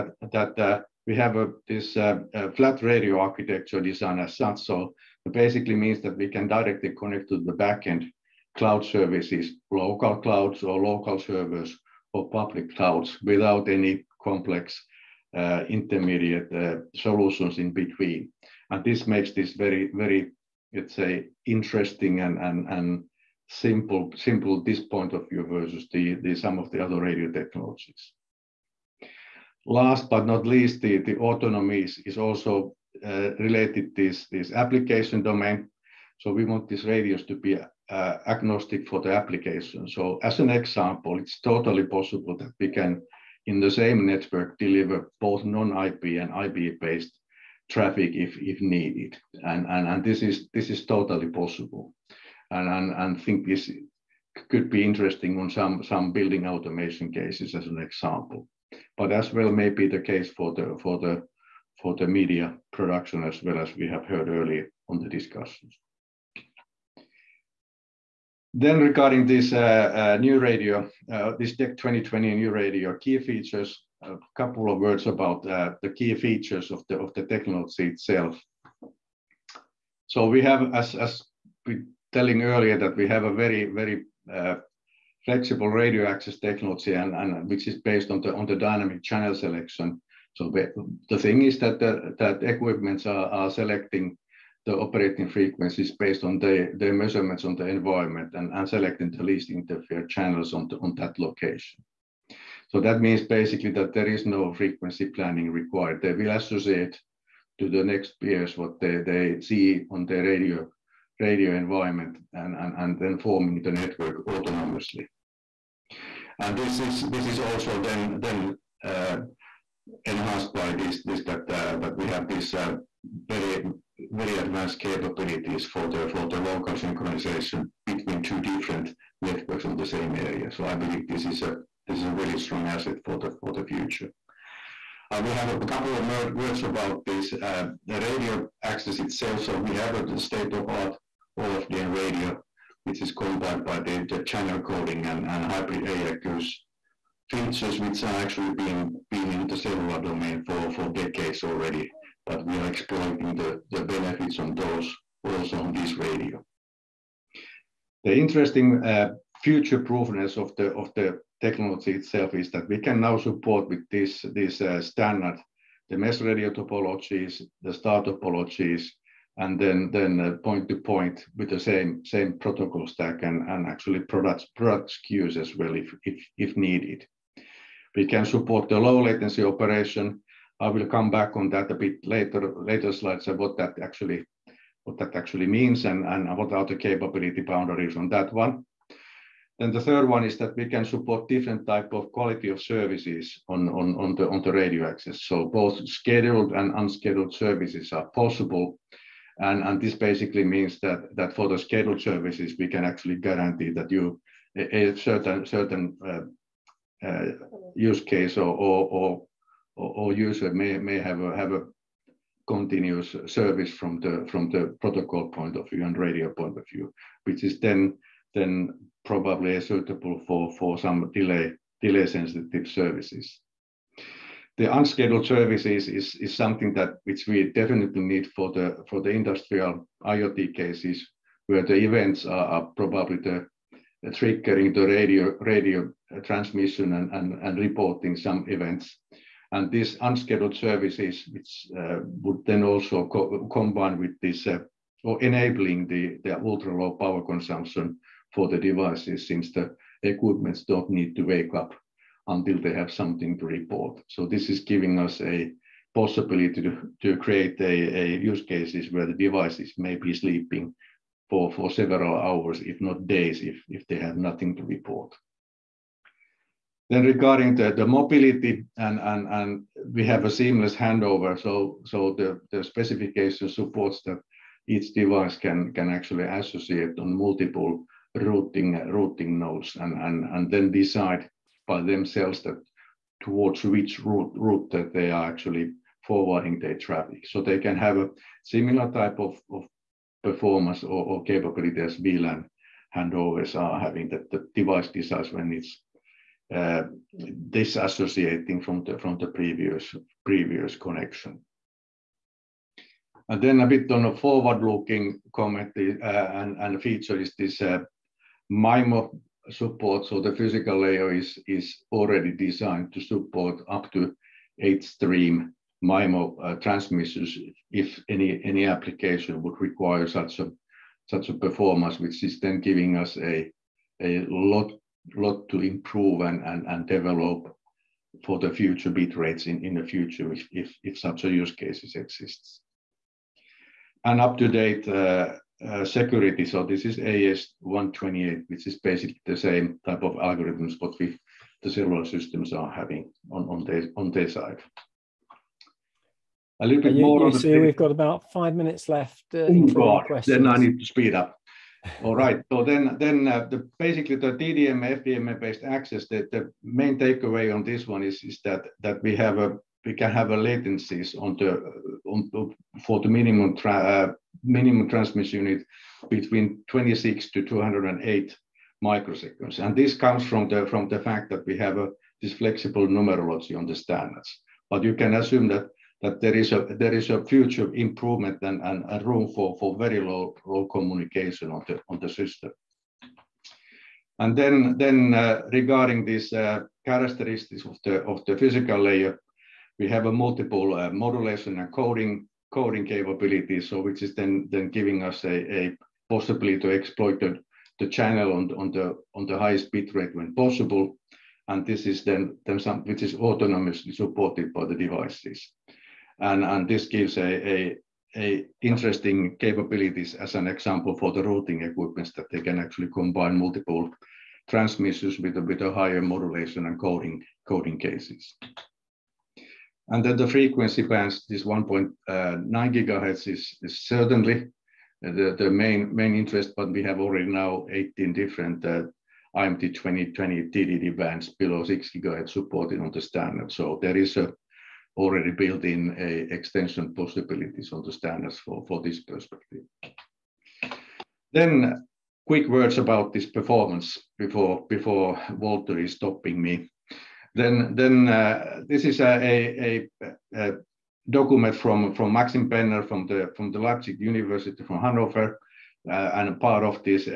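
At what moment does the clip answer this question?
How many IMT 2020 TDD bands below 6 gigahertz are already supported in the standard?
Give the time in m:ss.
7:07.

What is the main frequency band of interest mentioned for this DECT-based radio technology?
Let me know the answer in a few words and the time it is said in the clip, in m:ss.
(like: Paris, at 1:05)
1.9 gigahertz, at 7:01.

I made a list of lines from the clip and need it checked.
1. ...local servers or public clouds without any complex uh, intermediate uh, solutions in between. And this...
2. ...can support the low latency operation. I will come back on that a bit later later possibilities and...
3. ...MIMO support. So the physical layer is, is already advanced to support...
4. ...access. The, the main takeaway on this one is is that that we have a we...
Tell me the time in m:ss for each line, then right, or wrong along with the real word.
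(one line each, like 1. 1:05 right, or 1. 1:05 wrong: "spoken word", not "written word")
1. 0:10 right
2. 2:58 wrong: "slides", not "possibilities"
3. 5:08 wrong: "designed", not "advanced"
4. 5:55 right.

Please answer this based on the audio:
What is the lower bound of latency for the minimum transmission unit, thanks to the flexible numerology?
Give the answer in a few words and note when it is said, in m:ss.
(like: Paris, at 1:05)
26 microseconds, at 6:06.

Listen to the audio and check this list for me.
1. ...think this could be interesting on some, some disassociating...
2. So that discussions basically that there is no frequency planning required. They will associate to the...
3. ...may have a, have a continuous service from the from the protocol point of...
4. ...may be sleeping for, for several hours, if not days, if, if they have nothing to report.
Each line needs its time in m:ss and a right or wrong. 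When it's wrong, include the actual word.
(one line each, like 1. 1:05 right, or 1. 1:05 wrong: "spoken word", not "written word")
1. 0:53 wrong: "building", not "disassociating"
2. 1:42 wrong: "means", not "discussions"
3. 3:30 right
4. 4:19 right.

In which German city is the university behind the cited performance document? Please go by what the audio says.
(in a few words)
Hanover.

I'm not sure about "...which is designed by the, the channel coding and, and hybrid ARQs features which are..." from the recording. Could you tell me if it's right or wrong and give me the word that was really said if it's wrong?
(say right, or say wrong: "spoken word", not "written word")
wrong: "combined", not "designed".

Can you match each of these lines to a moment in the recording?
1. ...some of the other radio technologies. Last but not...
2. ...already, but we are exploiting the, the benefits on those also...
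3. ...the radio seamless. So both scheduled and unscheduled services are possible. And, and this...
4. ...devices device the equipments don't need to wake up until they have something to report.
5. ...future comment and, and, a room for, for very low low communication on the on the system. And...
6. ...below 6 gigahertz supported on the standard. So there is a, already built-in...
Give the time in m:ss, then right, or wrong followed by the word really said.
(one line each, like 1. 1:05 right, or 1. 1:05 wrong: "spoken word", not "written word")
1. 0:26 right
2. 2:31 right
3. 3:14 wrong: "access", not "seamless"
4. 4:08 wrong: "since", not "device"
5. 6:17 wrong: "improvement", not "comment"
6. 7:11 right.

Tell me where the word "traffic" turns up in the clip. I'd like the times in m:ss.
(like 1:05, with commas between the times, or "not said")
0:47, 4:46.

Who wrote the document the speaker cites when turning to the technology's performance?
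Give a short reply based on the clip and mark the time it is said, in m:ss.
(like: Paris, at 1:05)
Maxim Penner, at 7:32.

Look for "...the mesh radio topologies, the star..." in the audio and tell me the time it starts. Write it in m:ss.
2:45.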